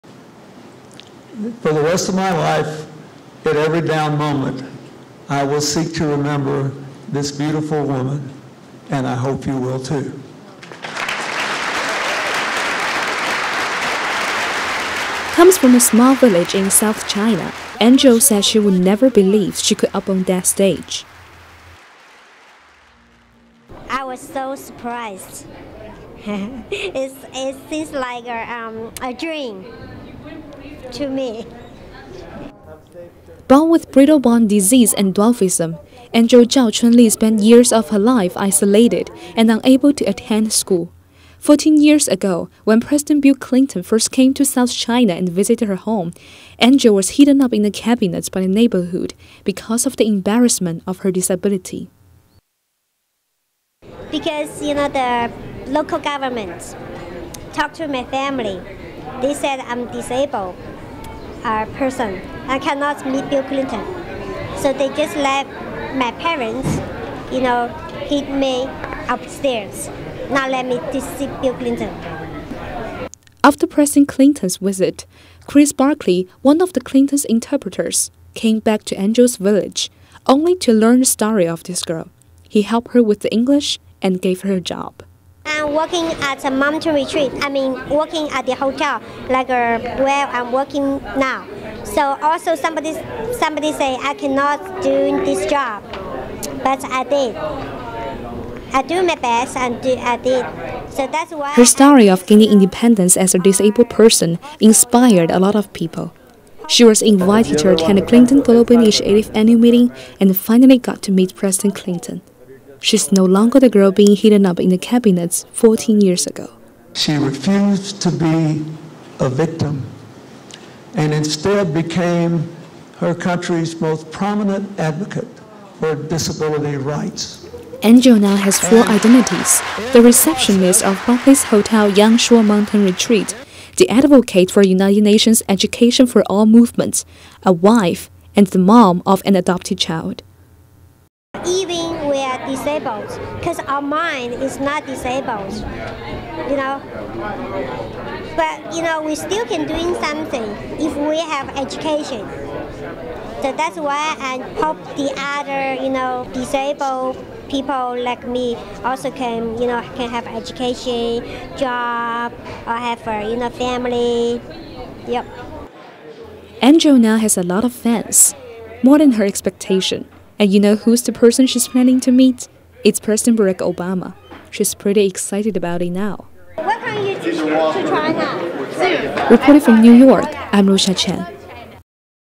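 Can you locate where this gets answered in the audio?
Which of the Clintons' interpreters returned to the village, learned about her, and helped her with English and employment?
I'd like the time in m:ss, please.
1:15.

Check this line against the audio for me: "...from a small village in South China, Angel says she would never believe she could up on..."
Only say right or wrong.
right.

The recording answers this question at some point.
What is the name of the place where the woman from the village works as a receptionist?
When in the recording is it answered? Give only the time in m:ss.
2:11.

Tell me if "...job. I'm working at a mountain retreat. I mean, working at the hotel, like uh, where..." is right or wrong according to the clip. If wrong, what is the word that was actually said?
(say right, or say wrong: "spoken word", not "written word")
right.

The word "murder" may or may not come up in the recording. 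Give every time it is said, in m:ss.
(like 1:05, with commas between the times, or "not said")
not said.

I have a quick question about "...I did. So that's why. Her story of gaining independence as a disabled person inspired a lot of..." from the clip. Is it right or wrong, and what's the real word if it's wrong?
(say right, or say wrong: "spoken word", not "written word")
right.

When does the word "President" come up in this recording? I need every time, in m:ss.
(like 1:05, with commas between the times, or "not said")
0:42, 1:13, 1:51, 2:52.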